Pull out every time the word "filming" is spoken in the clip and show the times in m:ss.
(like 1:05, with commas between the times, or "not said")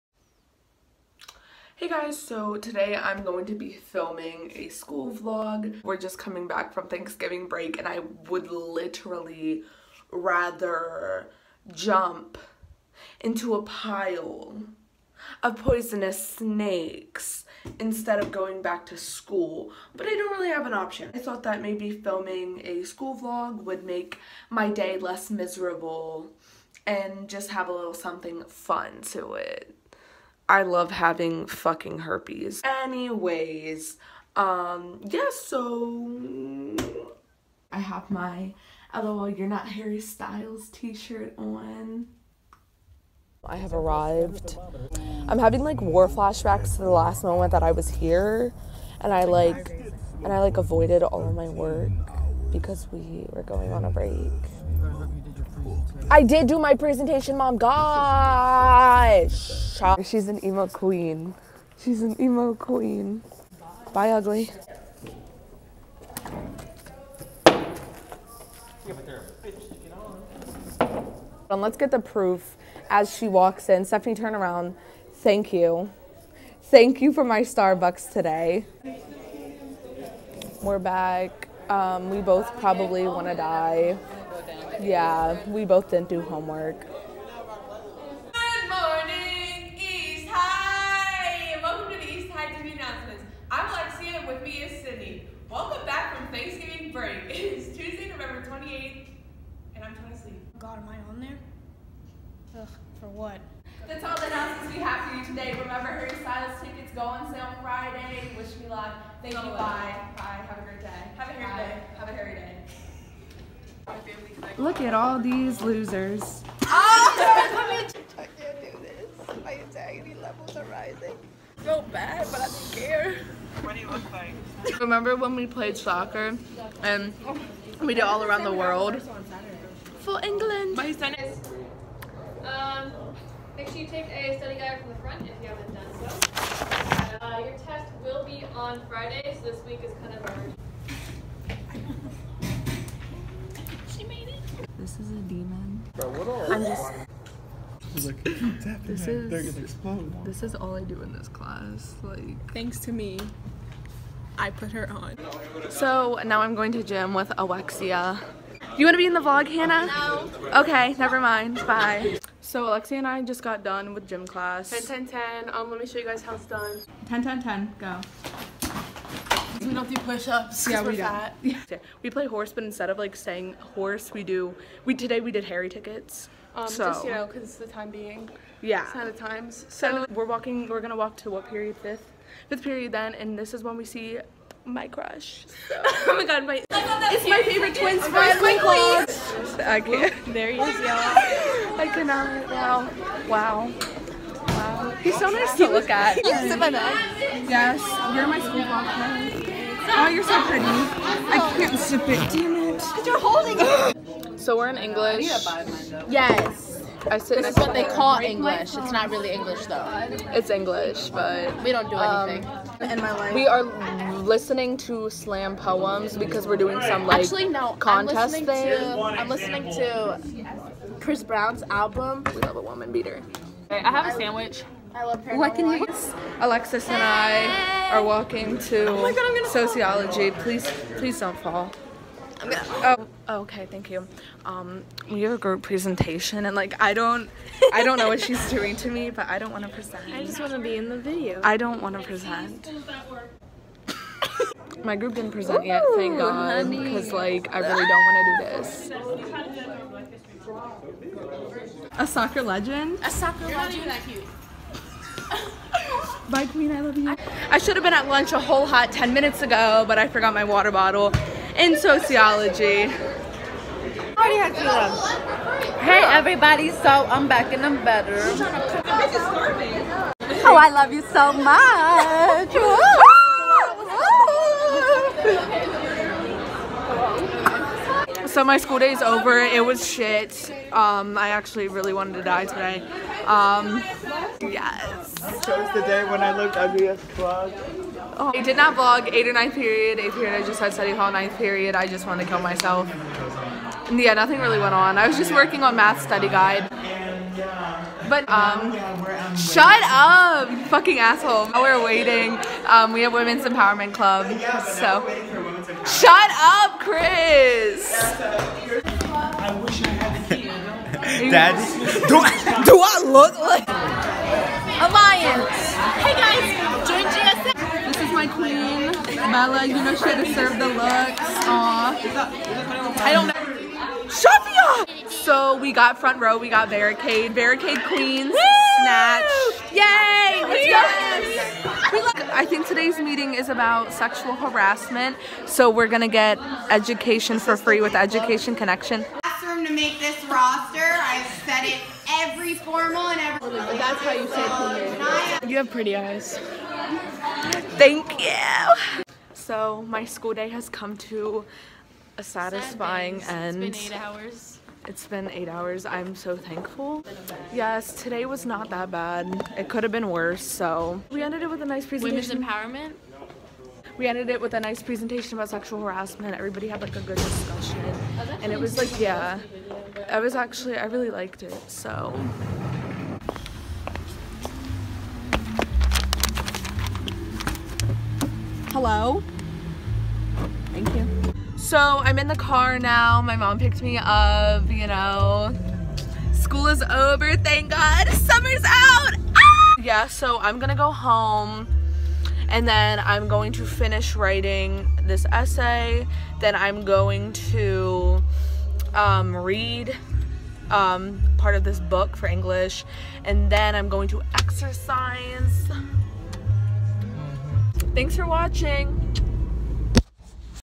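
0:03, 0:21.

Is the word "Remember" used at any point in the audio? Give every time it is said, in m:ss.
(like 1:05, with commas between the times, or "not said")
1:45, 2:04.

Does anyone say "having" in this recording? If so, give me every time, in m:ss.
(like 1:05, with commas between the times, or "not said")
0:30, 0:45.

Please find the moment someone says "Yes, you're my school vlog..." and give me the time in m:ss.
3:16.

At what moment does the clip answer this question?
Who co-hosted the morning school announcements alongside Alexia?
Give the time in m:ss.
1:34.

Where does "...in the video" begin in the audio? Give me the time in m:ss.
4:00.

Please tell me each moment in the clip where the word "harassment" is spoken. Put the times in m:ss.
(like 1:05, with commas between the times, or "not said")
5:34, 6:05.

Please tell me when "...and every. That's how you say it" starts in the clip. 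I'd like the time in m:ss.
5:43.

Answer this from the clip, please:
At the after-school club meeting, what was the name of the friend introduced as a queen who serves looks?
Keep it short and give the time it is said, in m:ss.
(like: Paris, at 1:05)
Bella, at 5:19.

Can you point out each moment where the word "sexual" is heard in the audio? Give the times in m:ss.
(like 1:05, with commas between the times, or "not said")
5:33, 6:05.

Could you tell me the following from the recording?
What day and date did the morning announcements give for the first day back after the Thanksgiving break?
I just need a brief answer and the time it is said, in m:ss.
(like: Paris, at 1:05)
Tuesday, November 28, at 1:37.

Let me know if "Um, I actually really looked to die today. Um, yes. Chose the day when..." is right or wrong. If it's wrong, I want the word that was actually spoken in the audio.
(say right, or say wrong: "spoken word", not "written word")
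wrong: "wanted", not "looked".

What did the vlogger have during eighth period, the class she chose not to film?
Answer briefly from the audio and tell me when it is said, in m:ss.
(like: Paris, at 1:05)
Study hall, at 4:50.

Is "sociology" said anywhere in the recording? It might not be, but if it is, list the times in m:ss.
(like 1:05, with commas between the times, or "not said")
3:49, 4:21.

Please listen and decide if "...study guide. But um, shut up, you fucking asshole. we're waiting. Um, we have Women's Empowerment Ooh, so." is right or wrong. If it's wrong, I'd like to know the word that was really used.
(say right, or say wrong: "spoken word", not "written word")
wrong: "Club", not "Ooh".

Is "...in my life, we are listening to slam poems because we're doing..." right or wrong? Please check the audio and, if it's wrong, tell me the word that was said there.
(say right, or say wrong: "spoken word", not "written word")
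right.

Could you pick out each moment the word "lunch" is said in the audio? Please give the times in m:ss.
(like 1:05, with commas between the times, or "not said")
4:18.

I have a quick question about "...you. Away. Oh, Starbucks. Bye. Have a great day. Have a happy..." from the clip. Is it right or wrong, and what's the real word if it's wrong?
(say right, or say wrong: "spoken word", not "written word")
wrong: "Bye", not "Starbucks".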